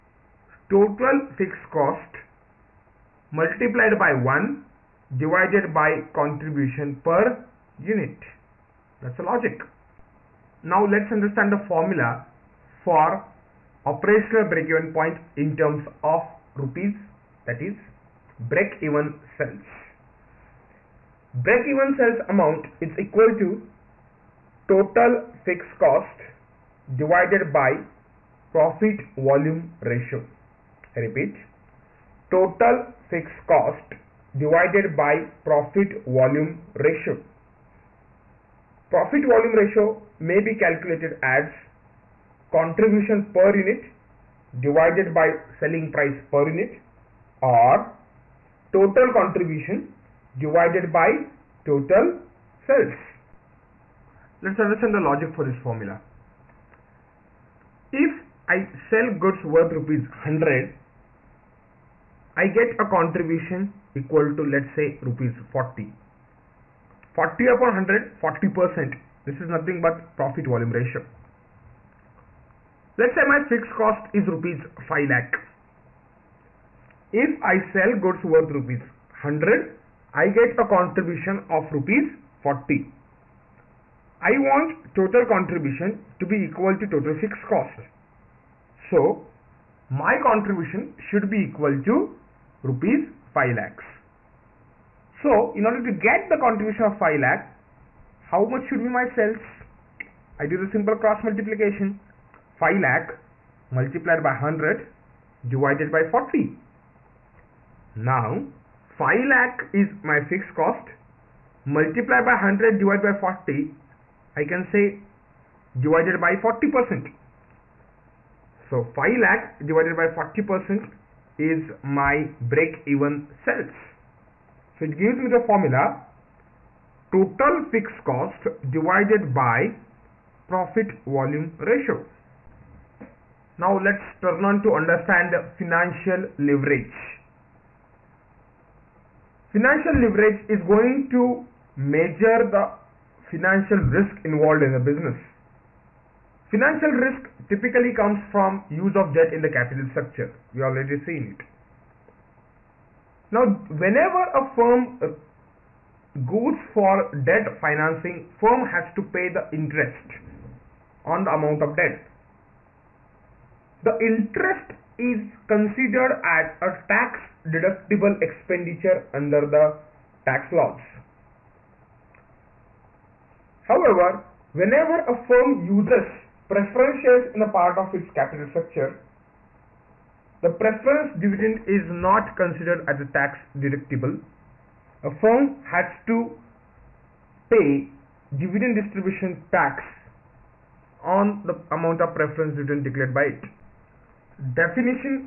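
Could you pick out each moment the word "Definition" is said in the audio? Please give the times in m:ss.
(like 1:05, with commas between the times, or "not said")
3:14.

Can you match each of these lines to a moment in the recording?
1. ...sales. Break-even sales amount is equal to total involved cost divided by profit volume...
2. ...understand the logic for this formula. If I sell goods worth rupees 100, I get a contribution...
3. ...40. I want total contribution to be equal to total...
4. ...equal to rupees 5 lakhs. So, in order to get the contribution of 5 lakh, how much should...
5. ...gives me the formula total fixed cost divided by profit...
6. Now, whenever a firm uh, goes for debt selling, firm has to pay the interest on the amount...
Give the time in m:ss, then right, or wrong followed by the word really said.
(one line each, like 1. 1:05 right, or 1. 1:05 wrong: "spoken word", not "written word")
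1. 0:19 wrong: "fixed", not "involved"
2. 0:54 right
3. 1:22 right
4. 1:31 right
5. 2:04 right
6. 2:33 wrong: "financing", not "selling".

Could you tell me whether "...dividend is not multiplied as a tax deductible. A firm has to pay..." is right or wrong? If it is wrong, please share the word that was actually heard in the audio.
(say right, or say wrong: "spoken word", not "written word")
wrong: "considered", not "multiplied".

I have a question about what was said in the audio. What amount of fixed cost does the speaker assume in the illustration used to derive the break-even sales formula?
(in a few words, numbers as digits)
5 lakh rupees.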